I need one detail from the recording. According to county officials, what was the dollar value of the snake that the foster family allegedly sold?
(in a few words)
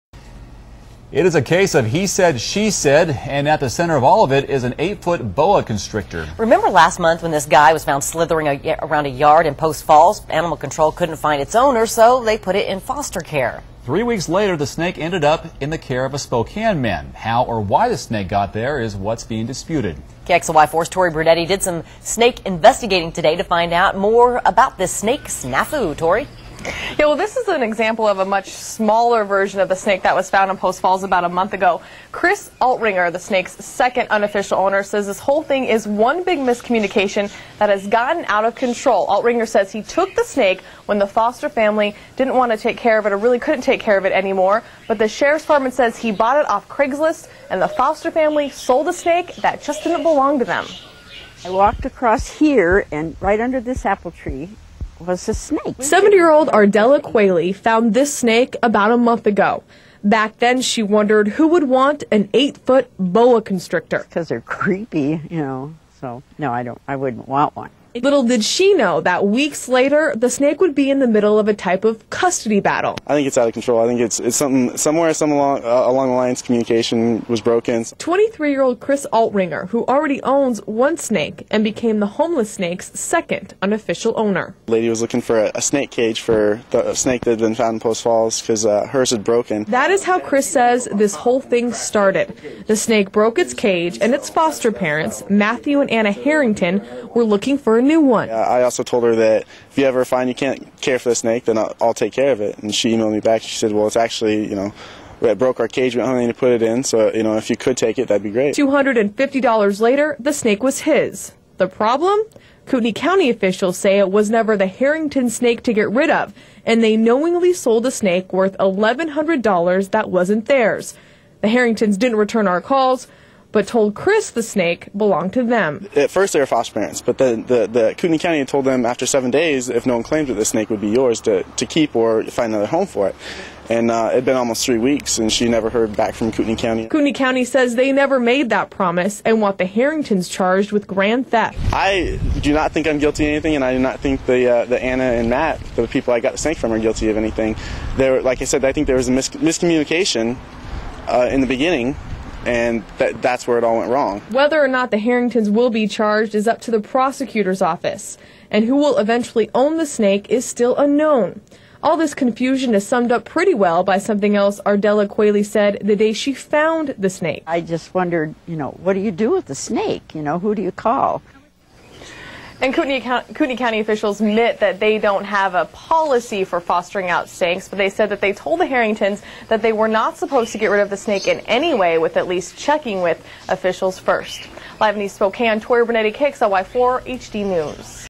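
$1,100.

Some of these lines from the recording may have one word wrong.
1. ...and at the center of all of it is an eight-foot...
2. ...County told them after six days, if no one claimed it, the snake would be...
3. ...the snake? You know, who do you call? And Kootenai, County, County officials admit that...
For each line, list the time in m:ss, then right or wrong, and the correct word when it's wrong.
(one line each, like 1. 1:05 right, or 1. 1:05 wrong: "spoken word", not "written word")
1. 0:03 right
2. 2:08 wrong: "seven", not "six"
3. 2:49 right.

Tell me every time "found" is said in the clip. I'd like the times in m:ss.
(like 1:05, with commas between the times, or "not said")
0:07, 0:30, 0:57, 1:27, 2:46.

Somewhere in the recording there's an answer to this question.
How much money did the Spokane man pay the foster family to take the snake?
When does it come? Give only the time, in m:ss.
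1:48.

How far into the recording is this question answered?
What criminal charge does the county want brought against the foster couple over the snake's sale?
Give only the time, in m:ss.
2:20.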